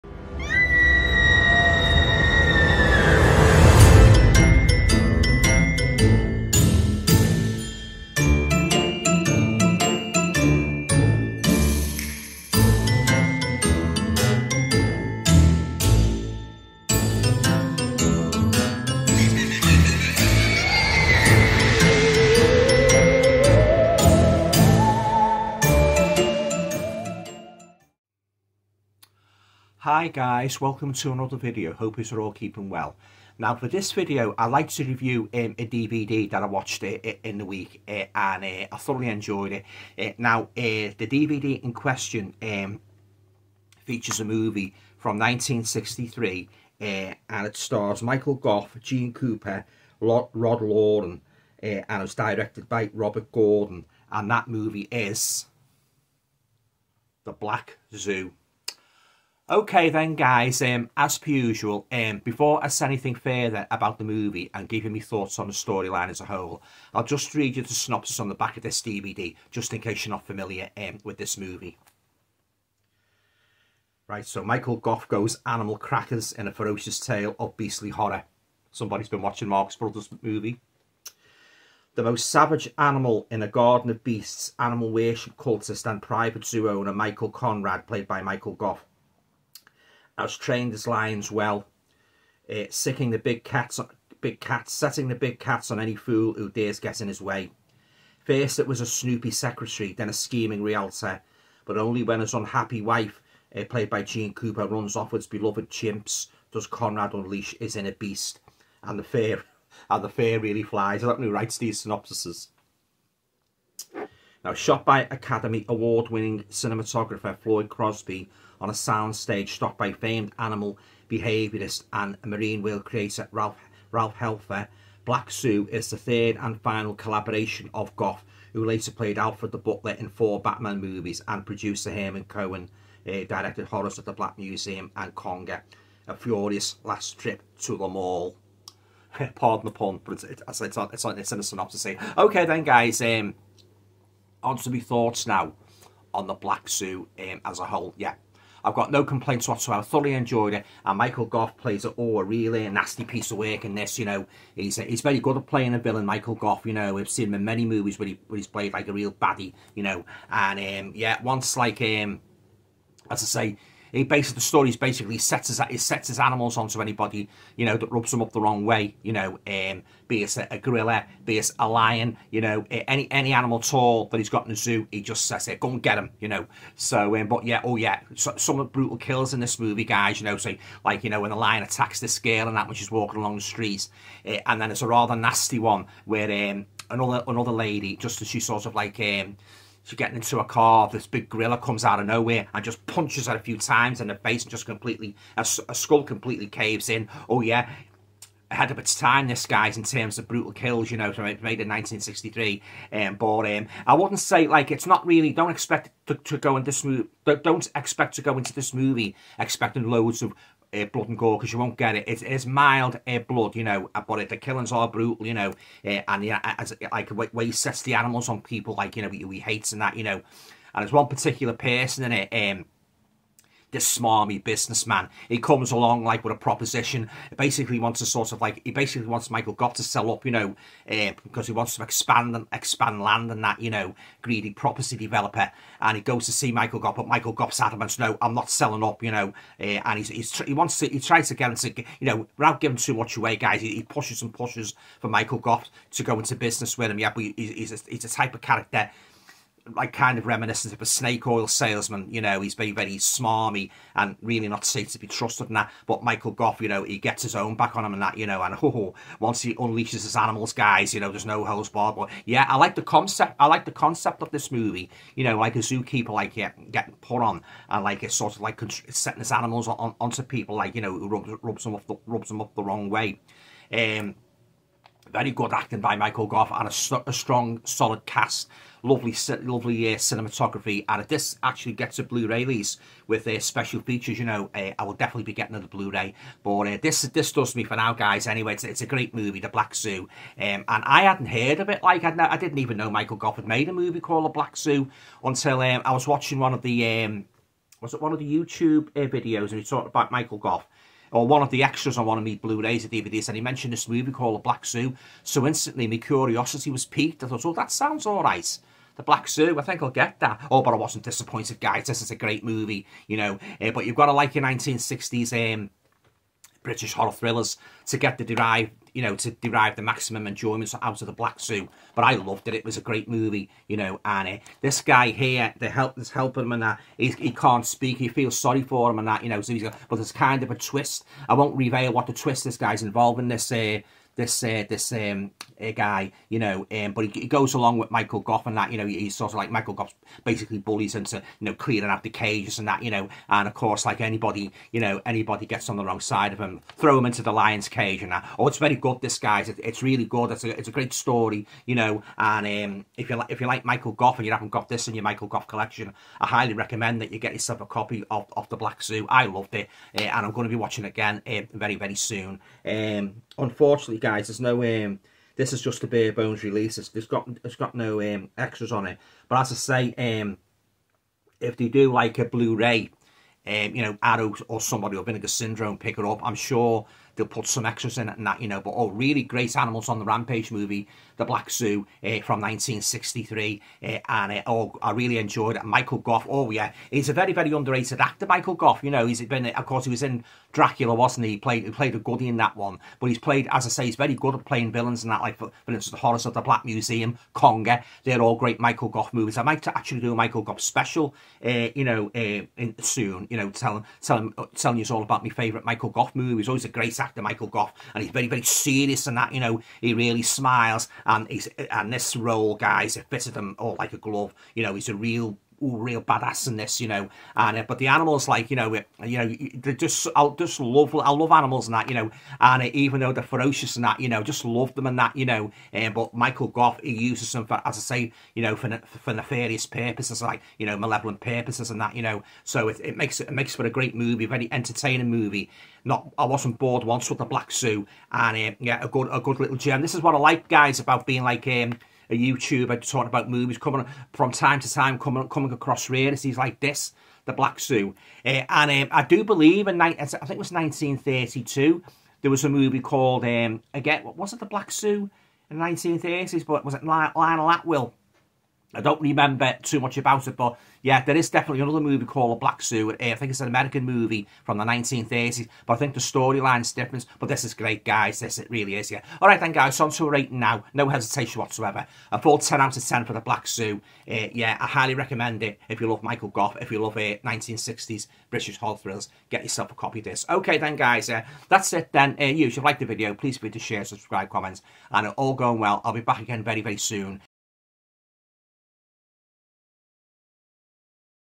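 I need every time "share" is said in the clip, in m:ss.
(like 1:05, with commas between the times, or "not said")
8:03.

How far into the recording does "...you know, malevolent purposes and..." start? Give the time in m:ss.
7:10.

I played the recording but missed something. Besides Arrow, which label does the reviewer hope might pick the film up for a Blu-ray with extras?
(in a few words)
Vinegar Syndrome.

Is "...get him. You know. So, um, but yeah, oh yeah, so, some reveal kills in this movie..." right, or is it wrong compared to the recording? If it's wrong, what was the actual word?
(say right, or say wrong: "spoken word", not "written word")
wrong: "brutal", not "reveal".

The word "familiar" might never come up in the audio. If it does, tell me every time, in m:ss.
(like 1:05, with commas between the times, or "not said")
1:10.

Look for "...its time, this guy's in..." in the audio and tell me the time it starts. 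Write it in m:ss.
3:18.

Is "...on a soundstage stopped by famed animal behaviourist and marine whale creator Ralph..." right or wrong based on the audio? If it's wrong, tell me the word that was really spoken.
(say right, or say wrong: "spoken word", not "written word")
right.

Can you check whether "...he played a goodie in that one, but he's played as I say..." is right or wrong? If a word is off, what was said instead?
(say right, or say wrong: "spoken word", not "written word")
right.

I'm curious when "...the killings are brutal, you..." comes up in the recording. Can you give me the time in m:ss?
3:34.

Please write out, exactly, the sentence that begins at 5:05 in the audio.
So instantly, my curiosity was piqued.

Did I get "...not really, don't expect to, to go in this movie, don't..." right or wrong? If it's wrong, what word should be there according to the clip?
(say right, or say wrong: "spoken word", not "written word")
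right.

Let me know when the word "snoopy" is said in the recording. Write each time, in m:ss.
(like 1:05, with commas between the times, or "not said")
1:38.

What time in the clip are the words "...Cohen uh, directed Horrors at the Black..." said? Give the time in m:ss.
2:12.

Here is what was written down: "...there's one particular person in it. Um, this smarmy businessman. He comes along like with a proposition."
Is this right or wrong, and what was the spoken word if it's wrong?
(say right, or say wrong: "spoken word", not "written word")
right.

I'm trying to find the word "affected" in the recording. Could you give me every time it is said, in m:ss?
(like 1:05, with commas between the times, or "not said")
not said.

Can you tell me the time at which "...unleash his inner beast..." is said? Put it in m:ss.
1:47.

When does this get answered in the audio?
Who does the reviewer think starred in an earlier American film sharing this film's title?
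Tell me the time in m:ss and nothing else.
7:36.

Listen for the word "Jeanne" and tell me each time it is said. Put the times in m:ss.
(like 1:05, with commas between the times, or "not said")
0:48, 1:44.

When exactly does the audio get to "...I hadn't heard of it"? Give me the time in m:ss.
4:50.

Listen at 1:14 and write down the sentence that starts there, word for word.
Right, so Michael Gough goes animal crackers in a ferocious tale of beastly horror.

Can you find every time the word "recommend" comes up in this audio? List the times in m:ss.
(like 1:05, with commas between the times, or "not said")
5:56, 7:54.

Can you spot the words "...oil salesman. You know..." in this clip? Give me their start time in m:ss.
4:11.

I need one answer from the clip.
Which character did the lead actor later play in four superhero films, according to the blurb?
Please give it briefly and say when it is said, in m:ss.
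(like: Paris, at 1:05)
Alfred the Butler, at 2:09.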